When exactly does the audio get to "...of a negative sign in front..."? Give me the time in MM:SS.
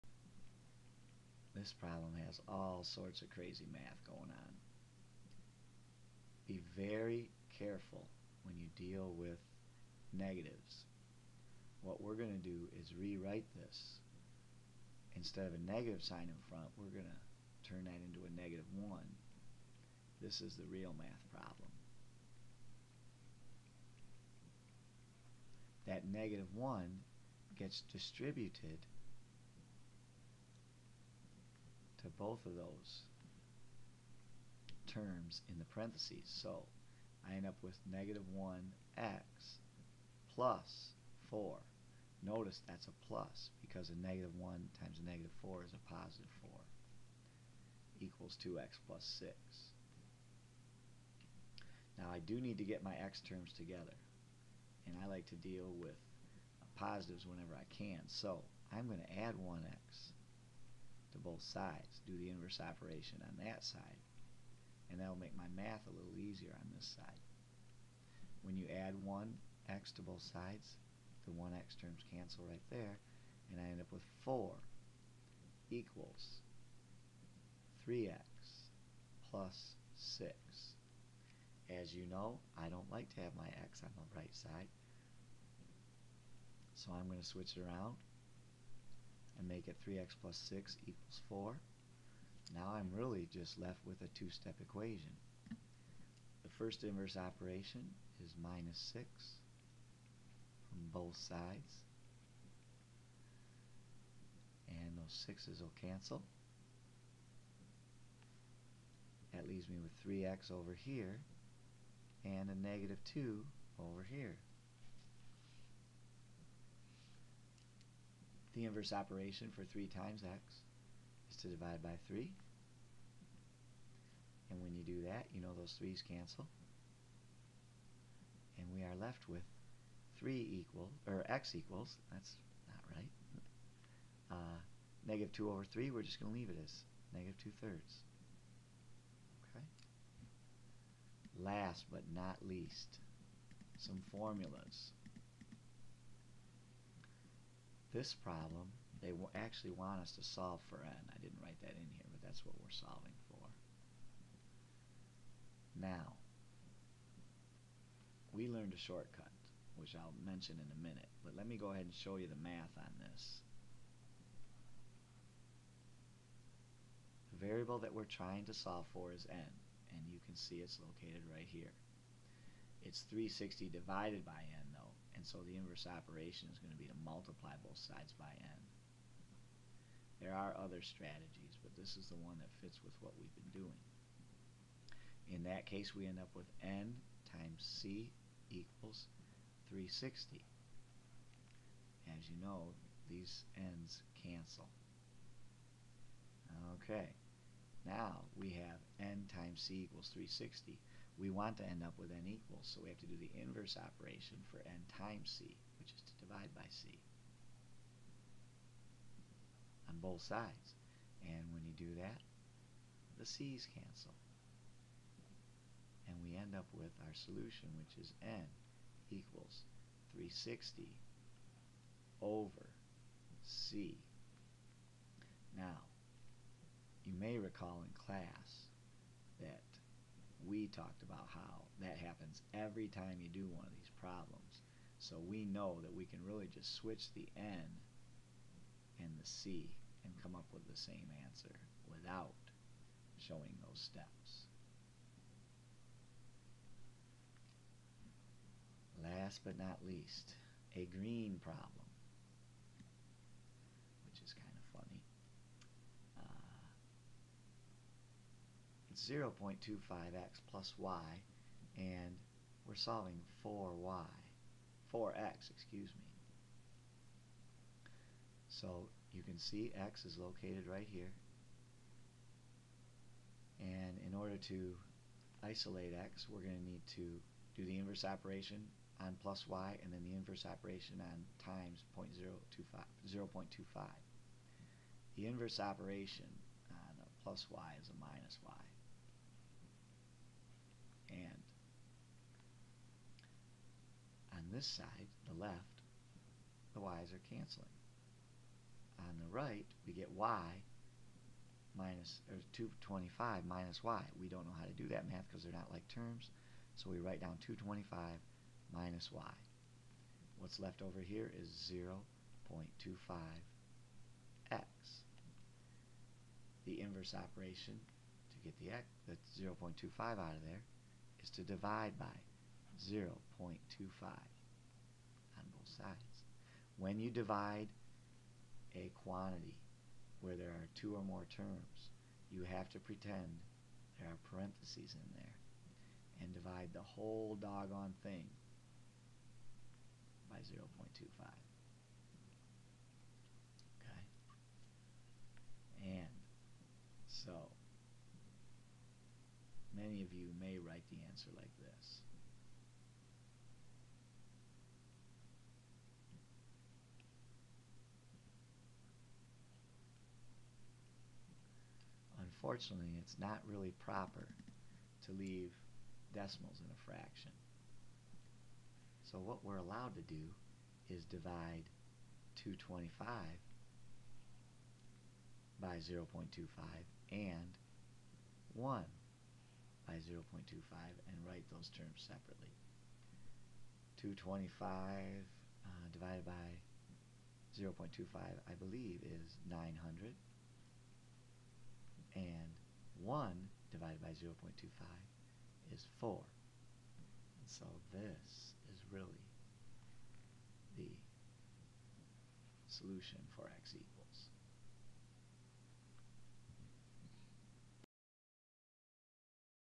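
00:15.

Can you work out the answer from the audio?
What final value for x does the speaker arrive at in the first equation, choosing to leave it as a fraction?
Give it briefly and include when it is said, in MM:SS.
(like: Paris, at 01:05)
-2/3, at 02:17.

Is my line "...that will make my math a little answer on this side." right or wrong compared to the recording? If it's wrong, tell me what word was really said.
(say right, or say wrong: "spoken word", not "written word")
wrong: "easier", not "answer".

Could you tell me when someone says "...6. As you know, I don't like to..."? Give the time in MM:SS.
01:20.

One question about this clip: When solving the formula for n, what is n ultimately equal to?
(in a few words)
360/c.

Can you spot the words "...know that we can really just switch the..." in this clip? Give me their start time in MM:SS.
03:55.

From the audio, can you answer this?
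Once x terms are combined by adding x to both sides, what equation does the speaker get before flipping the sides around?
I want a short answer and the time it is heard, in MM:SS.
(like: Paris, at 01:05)
4 = 3x + 6, at 01:14.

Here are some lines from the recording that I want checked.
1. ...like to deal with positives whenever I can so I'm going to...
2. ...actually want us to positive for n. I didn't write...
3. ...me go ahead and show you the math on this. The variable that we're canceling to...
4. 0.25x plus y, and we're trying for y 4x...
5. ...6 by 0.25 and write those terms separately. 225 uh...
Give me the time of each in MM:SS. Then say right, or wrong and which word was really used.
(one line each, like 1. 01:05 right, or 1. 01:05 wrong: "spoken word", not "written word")
1. 00:55 right
2. 02:29 wrong: "solve", not "positive"
3. 02:41 wrong: "trying", not "canceling"
4. 04:18 wrong: "solving", not "trying"
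5. 06:18 wrong: "1", not "6".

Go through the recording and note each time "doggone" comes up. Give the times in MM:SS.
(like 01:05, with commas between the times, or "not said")
05:37.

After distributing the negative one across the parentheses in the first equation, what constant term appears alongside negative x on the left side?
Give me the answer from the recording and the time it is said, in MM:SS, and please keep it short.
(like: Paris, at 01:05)
plus 4, at 00:40.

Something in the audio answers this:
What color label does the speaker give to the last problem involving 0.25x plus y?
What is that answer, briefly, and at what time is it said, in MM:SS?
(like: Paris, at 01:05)
green, at 04:10.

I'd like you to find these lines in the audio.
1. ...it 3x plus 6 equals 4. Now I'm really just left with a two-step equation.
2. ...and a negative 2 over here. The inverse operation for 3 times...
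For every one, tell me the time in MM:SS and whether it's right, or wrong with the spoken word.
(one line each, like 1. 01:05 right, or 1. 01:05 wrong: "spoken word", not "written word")
1. 01:29 right
2. 01:52 right.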